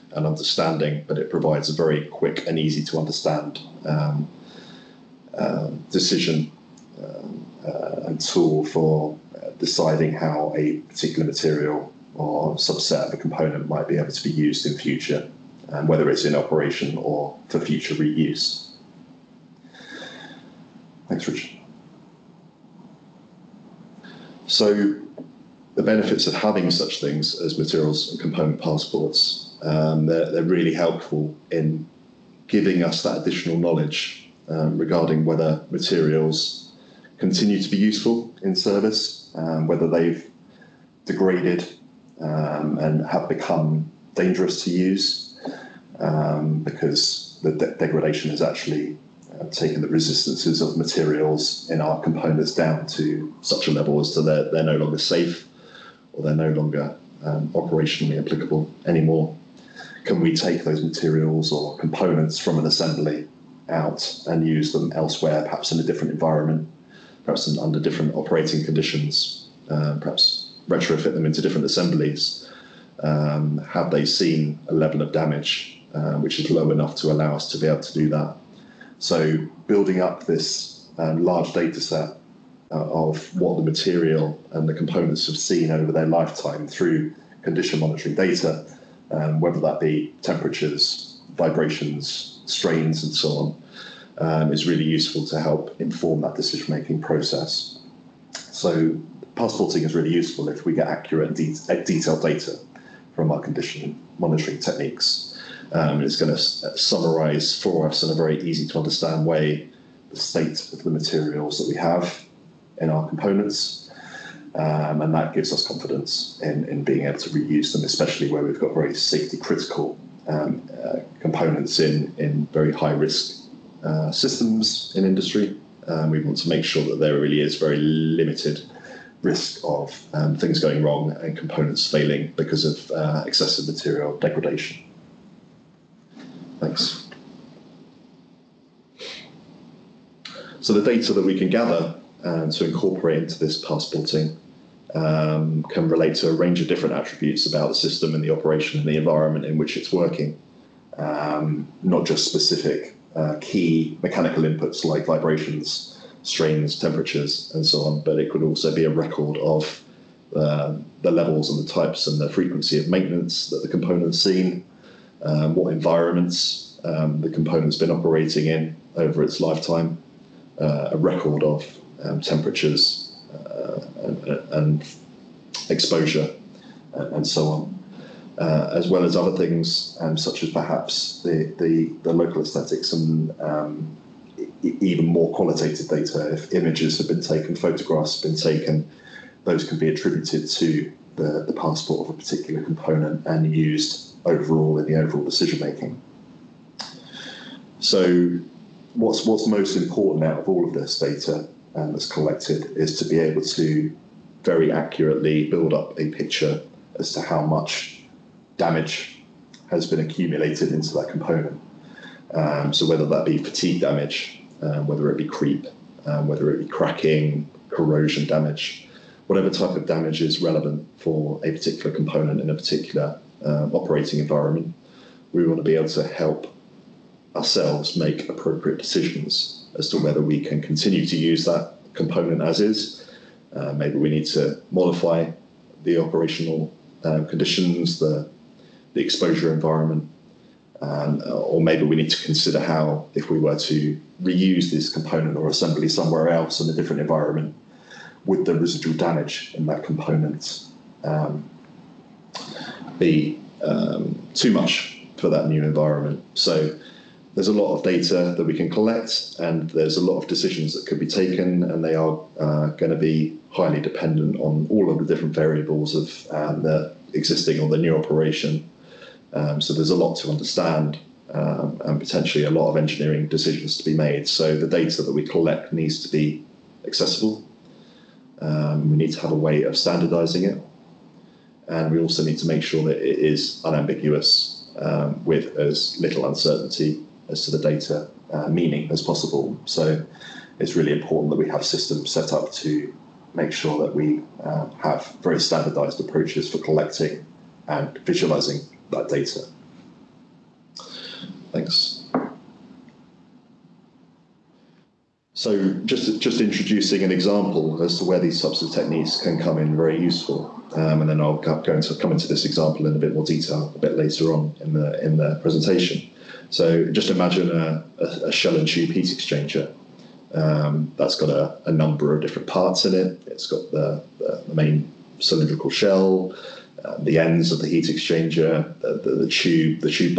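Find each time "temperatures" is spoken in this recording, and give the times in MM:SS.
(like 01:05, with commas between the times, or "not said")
01:30, 02:36, 02:52.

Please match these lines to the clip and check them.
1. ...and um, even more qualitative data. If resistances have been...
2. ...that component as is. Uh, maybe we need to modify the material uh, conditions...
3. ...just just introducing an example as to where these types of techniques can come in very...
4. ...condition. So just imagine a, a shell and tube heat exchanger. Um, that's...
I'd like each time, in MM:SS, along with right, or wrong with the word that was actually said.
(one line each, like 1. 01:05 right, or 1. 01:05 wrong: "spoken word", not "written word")
1. 03:02 wrong: "images", not "resistances"
2. 03:51 wrong: "operational", not "material"
3. 05:05 right
4. 05:15 wrong: "presentation", not "condition".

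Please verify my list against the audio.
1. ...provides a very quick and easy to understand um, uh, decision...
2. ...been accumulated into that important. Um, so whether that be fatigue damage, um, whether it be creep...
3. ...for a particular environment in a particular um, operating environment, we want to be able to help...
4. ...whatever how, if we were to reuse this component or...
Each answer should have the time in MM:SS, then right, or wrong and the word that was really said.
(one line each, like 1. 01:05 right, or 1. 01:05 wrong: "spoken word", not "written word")
1. 00:01 right
2. 03:29 wrong: "component", not "important"
3. 03:40 wrong: "component", not "environment"
4. 04:02 wrong: "consider", not "whatever".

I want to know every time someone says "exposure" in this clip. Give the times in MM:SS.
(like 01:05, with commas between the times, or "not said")
02:55, 03:59.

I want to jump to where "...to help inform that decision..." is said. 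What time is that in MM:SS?
01:35.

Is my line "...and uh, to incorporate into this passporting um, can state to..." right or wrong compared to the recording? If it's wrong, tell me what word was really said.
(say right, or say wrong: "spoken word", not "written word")
wrong: "relate", not "state".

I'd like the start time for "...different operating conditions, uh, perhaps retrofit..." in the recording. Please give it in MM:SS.
01:07.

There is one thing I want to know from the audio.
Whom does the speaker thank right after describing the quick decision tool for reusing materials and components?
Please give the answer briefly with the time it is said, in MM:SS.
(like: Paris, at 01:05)
Richard, at 00:21.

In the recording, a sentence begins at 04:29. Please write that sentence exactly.
Um, so there's a lot to understand, um, and potentially a lot of engineering decisions to be made.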